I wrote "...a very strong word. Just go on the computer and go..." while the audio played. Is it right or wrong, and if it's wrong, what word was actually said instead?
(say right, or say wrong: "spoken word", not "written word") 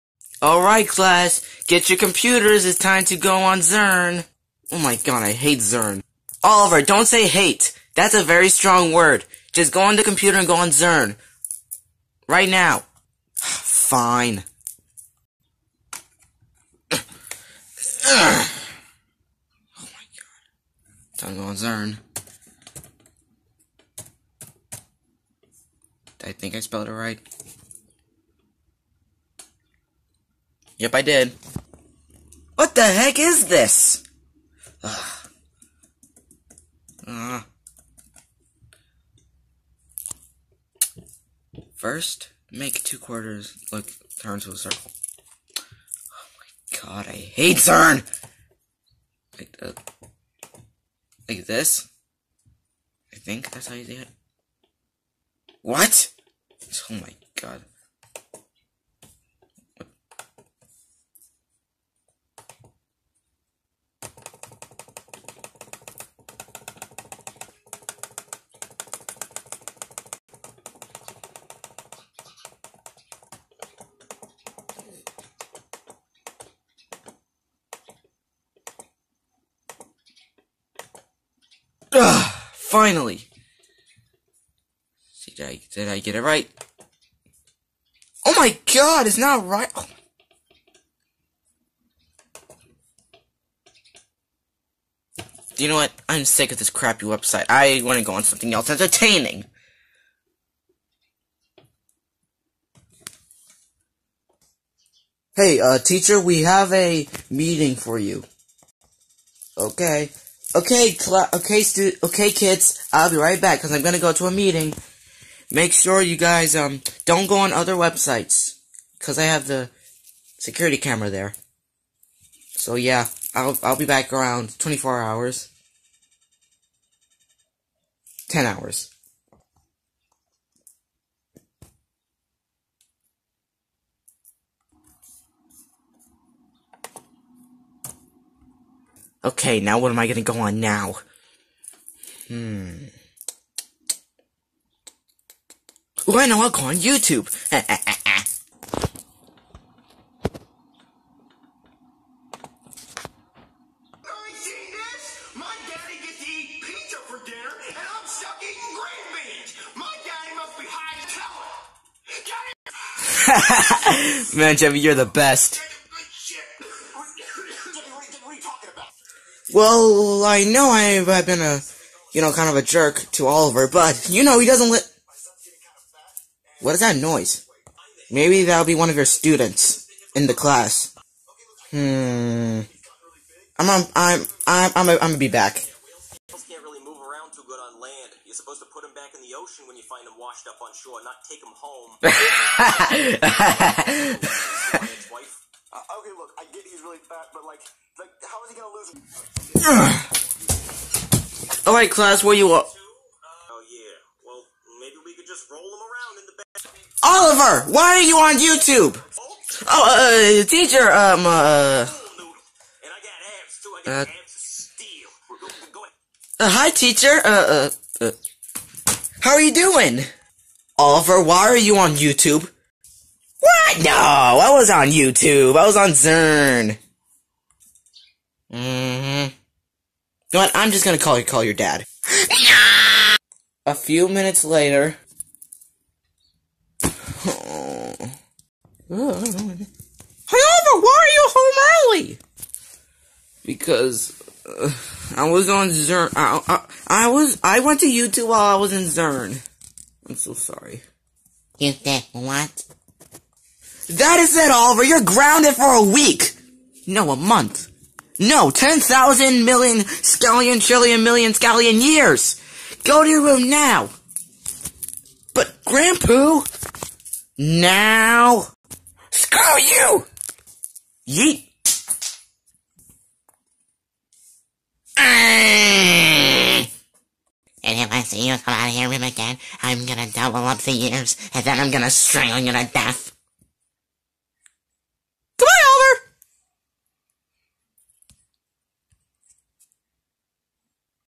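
right.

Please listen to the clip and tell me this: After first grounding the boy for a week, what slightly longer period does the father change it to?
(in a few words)
a month.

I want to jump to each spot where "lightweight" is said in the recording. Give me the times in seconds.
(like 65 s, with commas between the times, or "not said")
not said.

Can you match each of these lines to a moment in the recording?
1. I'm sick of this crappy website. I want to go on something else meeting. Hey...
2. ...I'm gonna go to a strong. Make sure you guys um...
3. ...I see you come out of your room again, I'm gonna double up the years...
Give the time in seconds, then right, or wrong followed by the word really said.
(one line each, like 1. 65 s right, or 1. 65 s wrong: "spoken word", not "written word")
1. 96 s wrong: "entertaining", not "meeting"
2. 113 s wrong: "meeting", not "strong"
3. 277 s right.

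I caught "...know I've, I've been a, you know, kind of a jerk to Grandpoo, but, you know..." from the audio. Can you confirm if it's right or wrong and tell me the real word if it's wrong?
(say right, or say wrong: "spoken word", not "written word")
wrong: "Oliver", not "Grandpoo".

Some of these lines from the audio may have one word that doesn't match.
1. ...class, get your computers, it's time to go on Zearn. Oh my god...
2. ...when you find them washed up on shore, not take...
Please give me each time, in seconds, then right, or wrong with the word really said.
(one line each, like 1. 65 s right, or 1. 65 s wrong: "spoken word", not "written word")
1. 0 s right
2. 189 s right.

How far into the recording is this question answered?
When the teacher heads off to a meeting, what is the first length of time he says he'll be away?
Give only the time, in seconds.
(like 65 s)
124 s.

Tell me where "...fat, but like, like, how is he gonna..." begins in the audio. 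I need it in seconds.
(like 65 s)
197 s.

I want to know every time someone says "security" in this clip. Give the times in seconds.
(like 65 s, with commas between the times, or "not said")
120 s.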